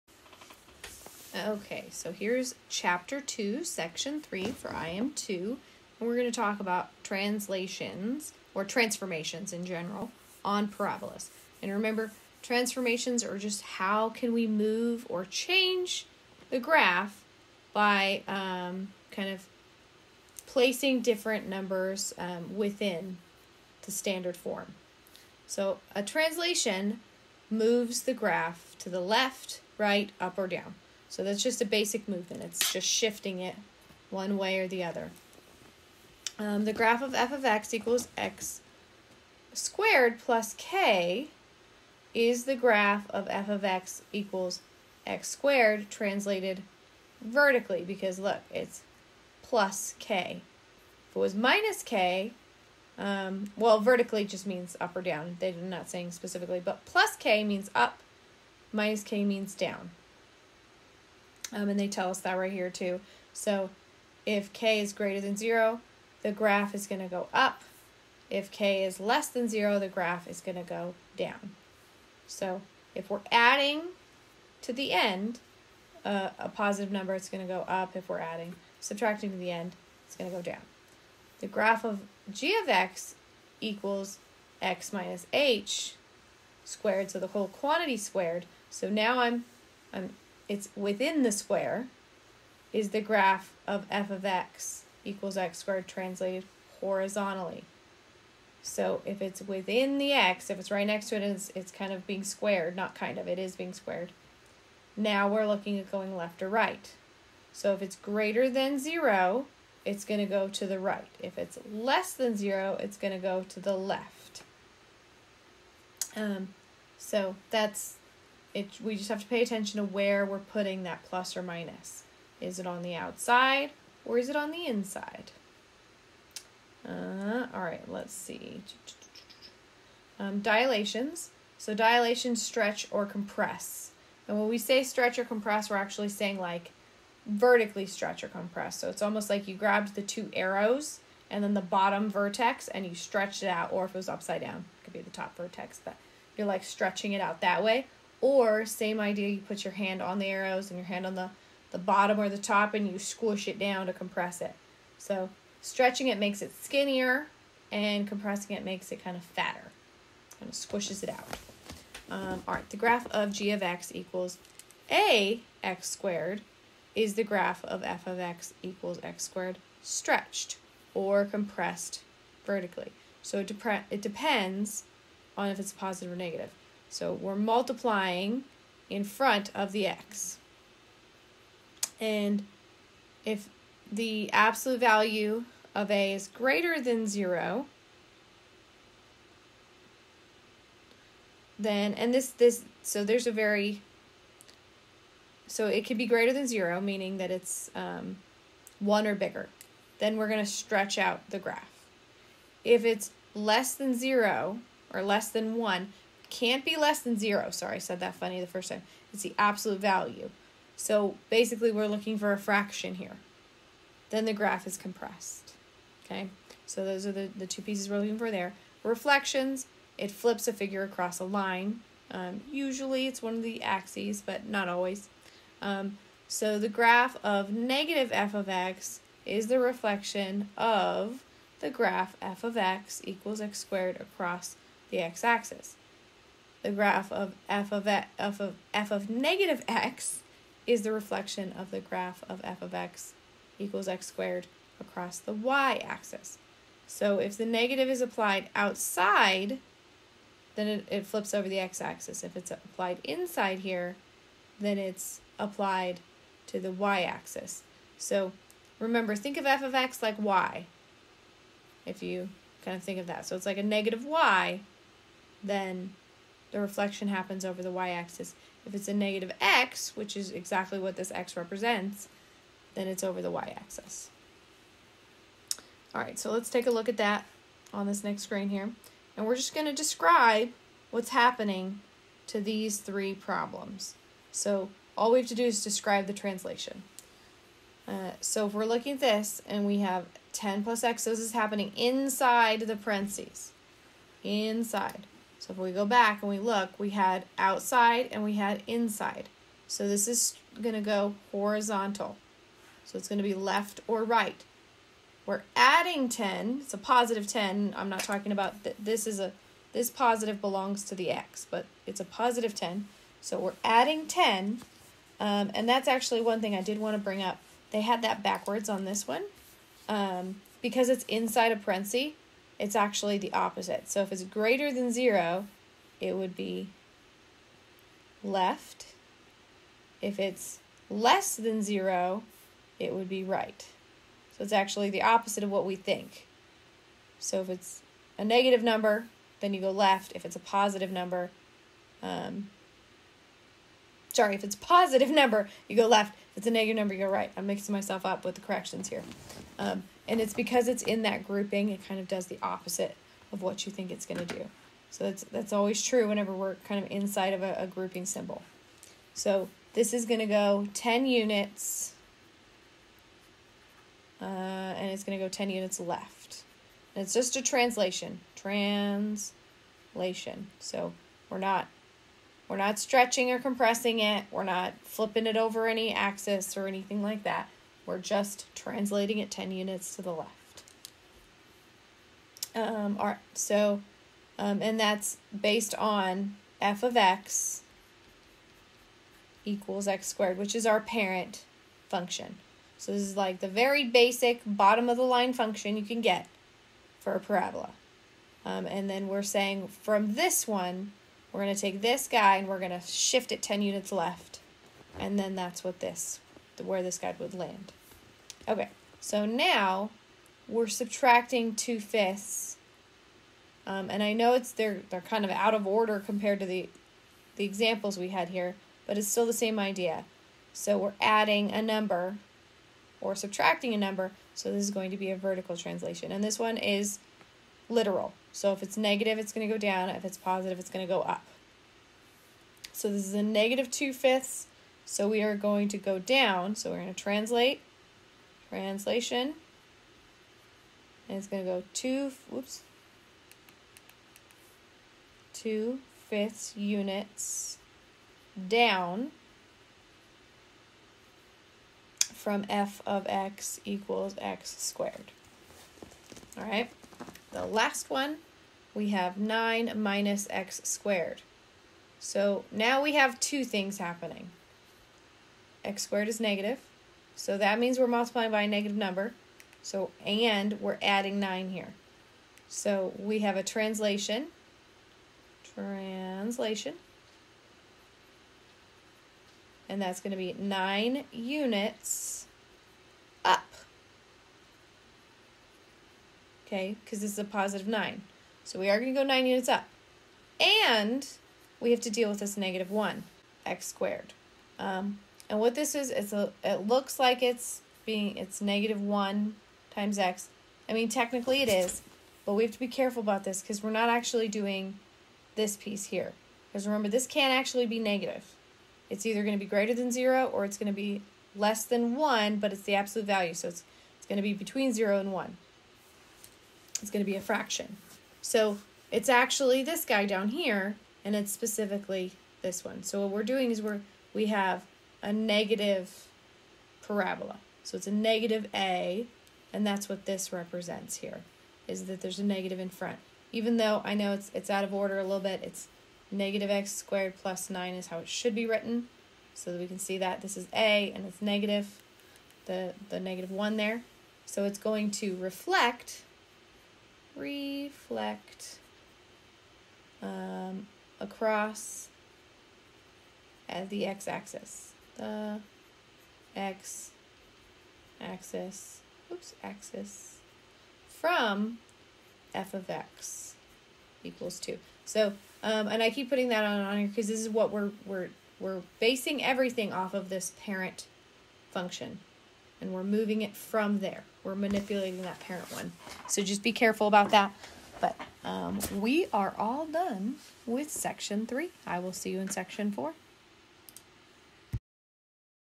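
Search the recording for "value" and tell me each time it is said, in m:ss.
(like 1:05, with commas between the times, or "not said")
3:04, 3:29, 8:33.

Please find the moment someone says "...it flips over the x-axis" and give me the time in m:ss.
4:10.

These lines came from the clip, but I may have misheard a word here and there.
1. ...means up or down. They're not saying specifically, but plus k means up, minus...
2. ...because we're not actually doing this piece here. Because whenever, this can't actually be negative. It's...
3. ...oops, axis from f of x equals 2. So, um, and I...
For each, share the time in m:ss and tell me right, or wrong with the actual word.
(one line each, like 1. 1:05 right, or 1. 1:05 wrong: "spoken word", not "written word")
1. 0:54 right
2. 8:23 wrong: "remember", not "whenever"
3. 9:19 right.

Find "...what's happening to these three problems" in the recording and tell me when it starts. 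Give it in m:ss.
4:40.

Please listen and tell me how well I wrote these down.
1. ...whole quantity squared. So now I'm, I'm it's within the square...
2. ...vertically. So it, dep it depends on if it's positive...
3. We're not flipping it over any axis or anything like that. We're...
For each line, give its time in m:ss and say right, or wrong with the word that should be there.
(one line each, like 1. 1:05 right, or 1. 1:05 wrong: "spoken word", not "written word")
1. 1:27 right
2. 2:52 right
3. 6:14 right.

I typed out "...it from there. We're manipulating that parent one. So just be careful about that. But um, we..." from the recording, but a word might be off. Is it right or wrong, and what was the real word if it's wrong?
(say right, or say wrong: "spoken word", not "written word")
right.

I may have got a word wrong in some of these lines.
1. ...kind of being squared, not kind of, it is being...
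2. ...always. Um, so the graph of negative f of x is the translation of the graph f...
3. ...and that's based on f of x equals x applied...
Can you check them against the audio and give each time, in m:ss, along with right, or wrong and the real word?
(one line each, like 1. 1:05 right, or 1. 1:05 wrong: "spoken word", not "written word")
1. 1:41 right
2. 3:44 wrong: "reflection", not "translation"
3. 6:24 wrong: "squared", not "applied".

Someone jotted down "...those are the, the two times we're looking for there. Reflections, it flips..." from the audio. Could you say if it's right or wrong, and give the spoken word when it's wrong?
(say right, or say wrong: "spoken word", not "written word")
wrong: "pieces", not "times".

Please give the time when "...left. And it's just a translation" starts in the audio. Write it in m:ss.
6:05.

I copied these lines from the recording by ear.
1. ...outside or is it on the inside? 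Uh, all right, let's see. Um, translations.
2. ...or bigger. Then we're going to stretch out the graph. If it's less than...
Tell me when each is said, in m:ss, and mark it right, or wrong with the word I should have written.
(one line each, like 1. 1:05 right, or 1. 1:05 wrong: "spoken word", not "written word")
1. 2:02 wrong: "dilations", not "translations"
2. 3:19 right.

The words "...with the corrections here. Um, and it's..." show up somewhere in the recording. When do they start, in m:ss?
5:48.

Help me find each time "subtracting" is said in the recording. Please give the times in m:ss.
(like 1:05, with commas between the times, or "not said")
1:18, 6:50, 7:03.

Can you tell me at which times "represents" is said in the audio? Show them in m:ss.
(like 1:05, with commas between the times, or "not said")
4:31, 8:50.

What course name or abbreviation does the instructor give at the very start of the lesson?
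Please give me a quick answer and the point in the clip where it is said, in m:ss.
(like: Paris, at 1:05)
IM2, at 0:04.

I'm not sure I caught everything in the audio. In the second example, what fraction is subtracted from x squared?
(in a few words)
2/5.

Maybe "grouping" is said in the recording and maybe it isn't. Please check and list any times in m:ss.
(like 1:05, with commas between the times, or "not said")
5:51, 5:57.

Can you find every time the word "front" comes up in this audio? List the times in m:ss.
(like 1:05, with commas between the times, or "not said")
2:59, 8:52.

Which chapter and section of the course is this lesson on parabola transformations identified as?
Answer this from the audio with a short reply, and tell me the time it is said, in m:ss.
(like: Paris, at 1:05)
Chapter 2, section 3, at 0:02.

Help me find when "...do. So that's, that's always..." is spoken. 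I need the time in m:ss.
5:54.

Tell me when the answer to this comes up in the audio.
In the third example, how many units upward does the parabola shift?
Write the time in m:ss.
8:09.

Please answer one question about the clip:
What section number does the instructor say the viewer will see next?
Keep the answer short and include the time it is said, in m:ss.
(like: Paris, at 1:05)
4, at 9:42.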